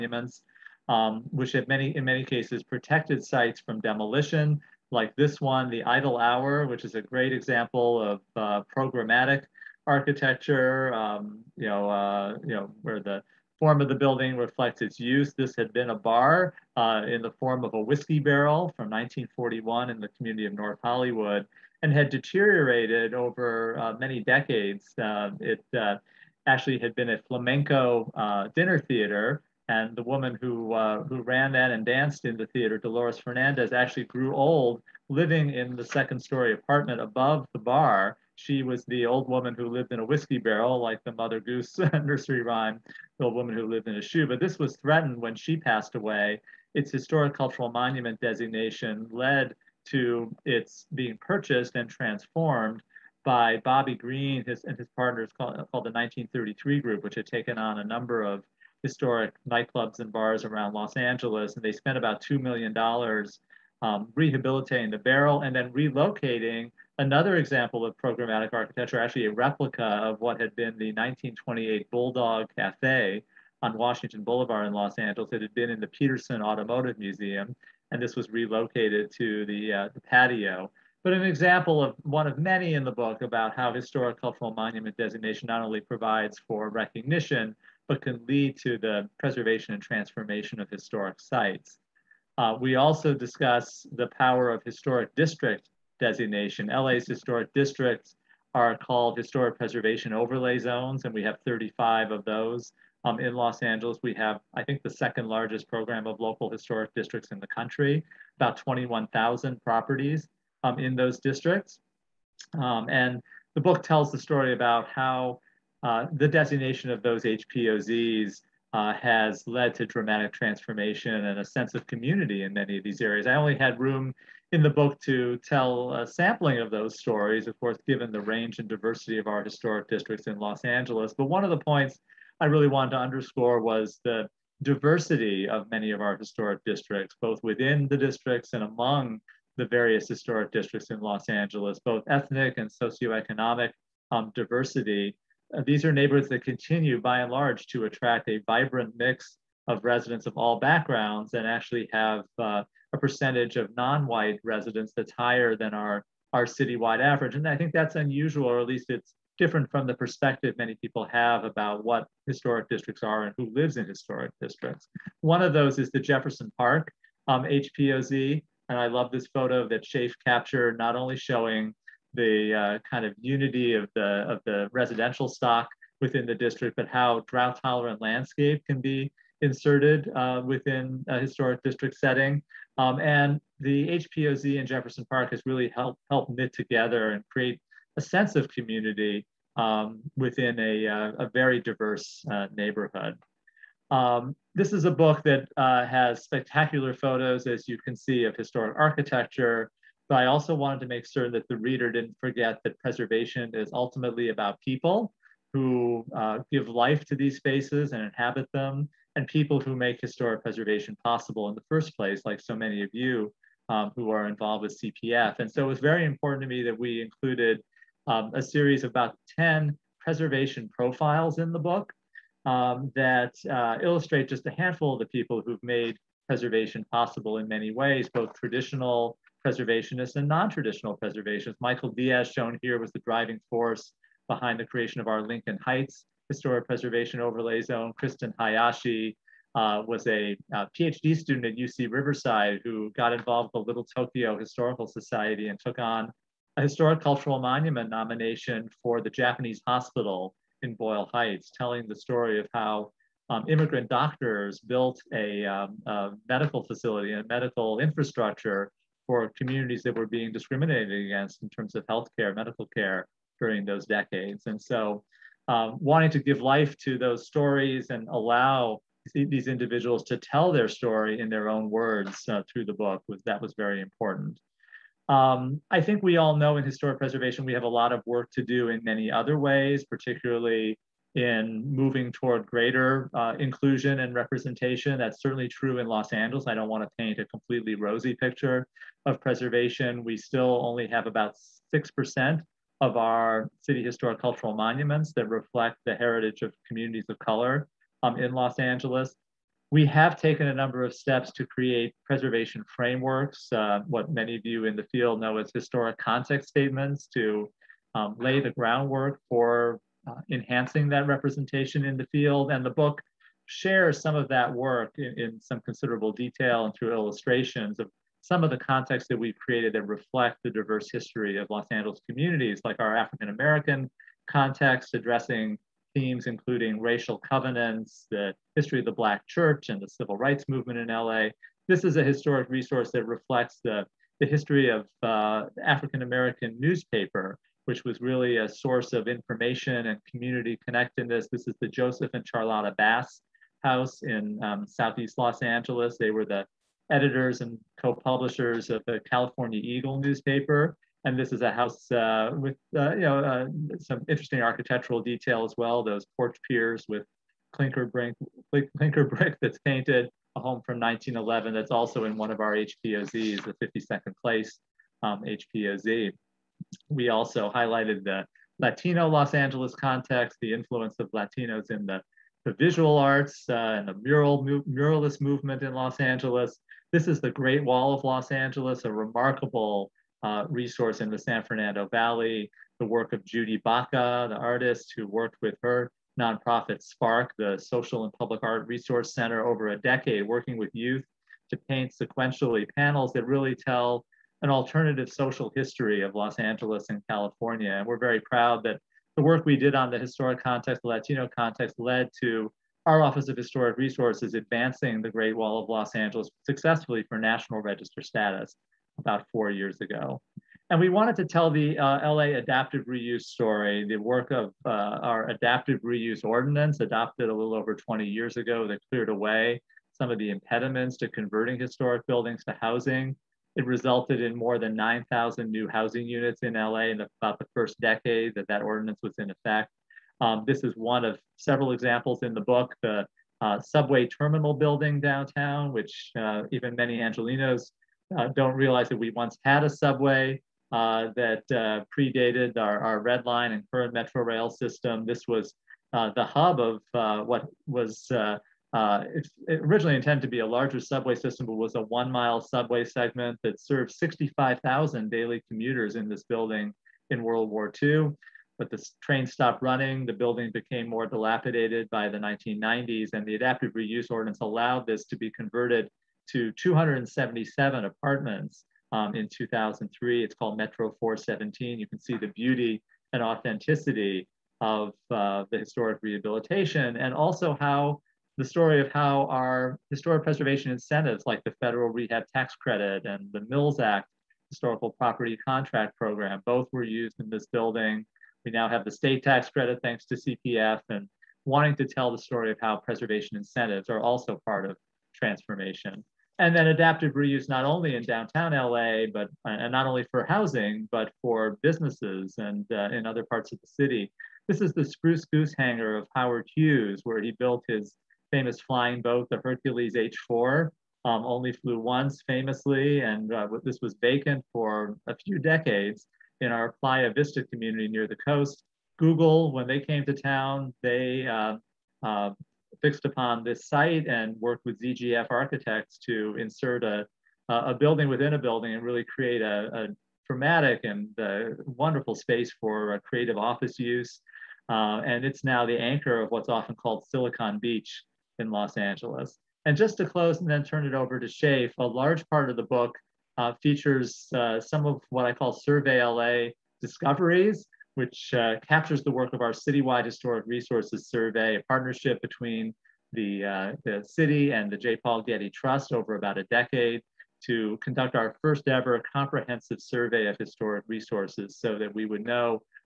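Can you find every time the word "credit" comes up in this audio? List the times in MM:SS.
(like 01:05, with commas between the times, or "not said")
08:02, 08:09.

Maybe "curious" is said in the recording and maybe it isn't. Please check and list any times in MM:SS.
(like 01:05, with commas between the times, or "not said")
not said.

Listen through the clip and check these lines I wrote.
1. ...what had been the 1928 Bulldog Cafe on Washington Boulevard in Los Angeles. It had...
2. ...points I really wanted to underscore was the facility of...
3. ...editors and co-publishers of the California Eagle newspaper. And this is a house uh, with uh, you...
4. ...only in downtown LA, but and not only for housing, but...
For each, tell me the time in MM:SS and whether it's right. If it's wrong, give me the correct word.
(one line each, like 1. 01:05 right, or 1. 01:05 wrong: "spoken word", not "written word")
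1. 01:10 right
2. 02:11 wrong: "diversity", not "facility"
3. 05:46 right
4. 08:17 right.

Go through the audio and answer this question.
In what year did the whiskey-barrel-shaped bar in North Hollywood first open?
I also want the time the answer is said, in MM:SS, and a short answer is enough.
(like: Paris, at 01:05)
1941, at 00:18.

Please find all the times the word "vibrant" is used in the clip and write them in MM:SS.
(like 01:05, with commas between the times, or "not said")
02:28.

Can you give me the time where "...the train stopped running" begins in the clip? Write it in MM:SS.
07:38.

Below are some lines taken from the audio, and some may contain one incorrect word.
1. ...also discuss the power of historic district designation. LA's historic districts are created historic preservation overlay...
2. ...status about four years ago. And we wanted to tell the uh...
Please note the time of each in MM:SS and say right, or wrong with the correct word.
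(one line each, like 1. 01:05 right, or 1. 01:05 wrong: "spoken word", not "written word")
1. 01:32 wrong: "called", not "created"
2. 06:48 right.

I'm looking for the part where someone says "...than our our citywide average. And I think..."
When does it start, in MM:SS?
02:35.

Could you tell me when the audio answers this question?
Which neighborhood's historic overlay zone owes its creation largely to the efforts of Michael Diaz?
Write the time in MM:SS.
03:55.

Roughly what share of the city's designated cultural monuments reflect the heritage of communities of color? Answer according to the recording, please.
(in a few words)
6%.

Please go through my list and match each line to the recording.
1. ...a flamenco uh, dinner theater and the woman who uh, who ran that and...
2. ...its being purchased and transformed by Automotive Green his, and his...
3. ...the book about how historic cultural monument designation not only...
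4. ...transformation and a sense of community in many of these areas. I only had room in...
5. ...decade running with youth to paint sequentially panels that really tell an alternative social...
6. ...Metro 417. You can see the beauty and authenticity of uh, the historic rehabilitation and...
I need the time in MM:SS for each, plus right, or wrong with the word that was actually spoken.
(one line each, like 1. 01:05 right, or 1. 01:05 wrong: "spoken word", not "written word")
1. 00:27 right
2. 00:50 wrong: "Bobby", not "Automotive"
3. 01:22 right
4. 02:00 right
5. 06:29 wrong: "working", not "running"
6. 07:50 right.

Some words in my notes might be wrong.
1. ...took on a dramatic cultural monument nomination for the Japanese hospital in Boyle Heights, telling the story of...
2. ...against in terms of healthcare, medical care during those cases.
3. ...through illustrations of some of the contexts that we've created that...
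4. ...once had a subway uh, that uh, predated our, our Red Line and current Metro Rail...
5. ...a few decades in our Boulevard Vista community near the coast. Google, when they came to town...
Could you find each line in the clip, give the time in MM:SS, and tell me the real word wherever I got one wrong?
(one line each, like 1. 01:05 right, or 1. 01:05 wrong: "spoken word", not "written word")
1. 04:05 wrong: "historic", not "dramatic"
2. 04:21 wrong: "decades", not "cases"
3. 05:16 right
4. 07:19 right
5. 08:35 wrong: "Playa", not "Boulevard".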